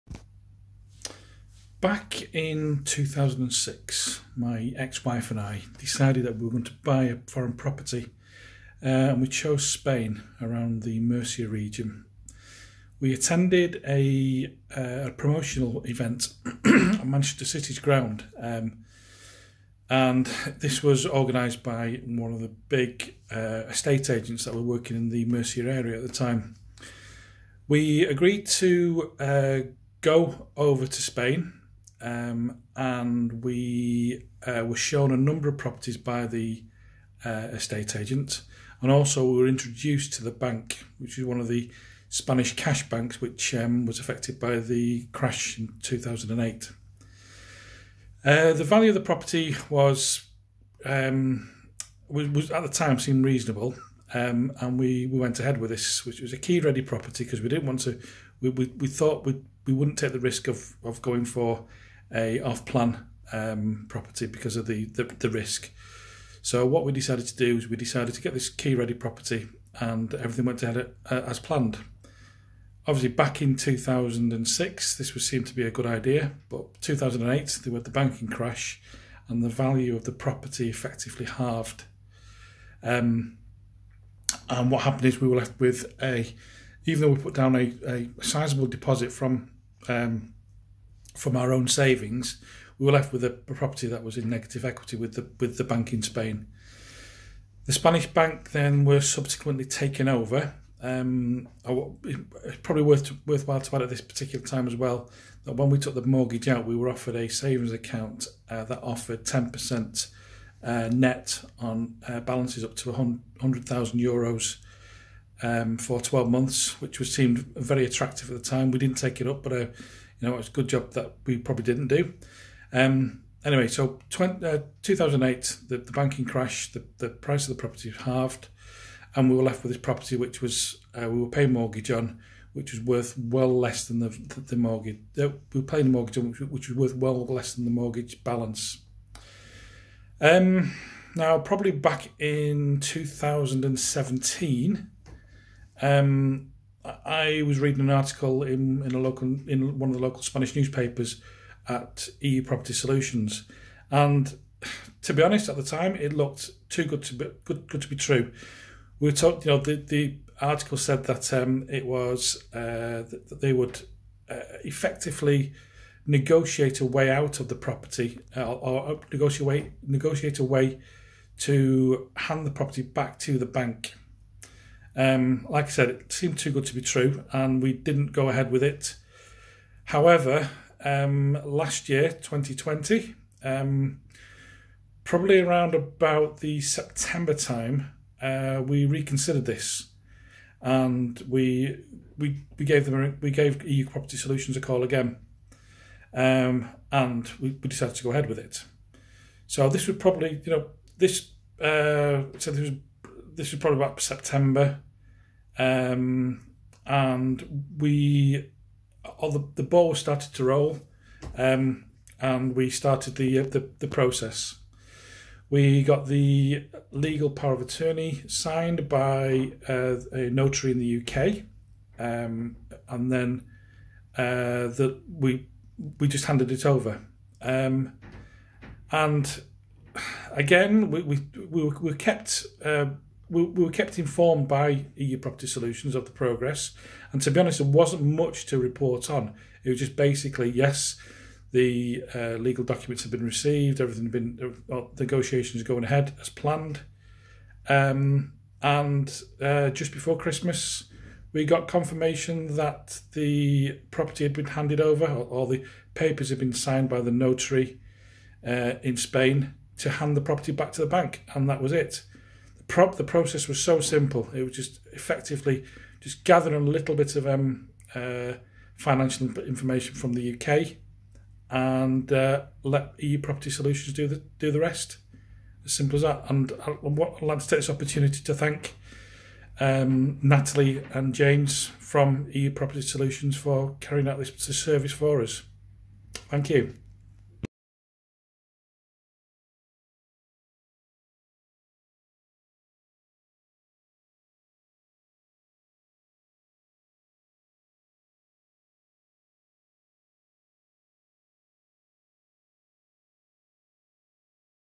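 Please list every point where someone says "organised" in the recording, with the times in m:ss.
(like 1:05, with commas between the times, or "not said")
0:21.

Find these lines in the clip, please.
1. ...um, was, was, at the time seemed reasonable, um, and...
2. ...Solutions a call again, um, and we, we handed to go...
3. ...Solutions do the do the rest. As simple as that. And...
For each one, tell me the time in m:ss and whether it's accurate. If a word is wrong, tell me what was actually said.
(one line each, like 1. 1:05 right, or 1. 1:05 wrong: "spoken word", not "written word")
1. 0:50 right
2. 3:14 wrong: "decided", not "handed"
3. 4:33 right.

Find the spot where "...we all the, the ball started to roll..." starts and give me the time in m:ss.
3:27.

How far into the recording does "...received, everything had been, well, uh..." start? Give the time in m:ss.
4:03.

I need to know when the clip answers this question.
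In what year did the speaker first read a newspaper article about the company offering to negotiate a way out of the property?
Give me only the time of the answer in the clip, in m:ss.
2:22.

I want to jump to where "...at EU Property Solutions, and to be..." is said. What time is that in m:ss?
2:31.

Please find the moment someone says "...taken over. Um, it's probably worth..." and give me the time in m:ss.
1:39.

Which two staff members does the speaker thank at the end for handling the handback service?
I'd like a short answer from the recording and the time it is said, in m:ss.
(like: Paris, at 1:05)
Natalie and James, at 4:40.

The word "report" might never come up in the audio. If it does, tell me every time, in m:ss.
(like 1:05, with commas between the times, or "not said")
3:58.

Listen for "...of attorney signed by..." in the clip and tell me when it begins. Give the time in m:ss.
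3:37.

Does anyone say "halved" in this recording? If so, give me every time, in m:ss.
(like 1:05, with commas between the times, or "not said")
1:21, 2:07.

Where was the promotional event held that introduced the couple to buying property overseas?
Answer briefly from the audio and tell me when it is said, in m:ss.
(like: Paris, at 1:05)
Manchester City's ground, at 0:17.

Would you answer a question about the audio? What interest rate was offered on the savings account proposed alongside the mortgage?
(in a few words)
10% net.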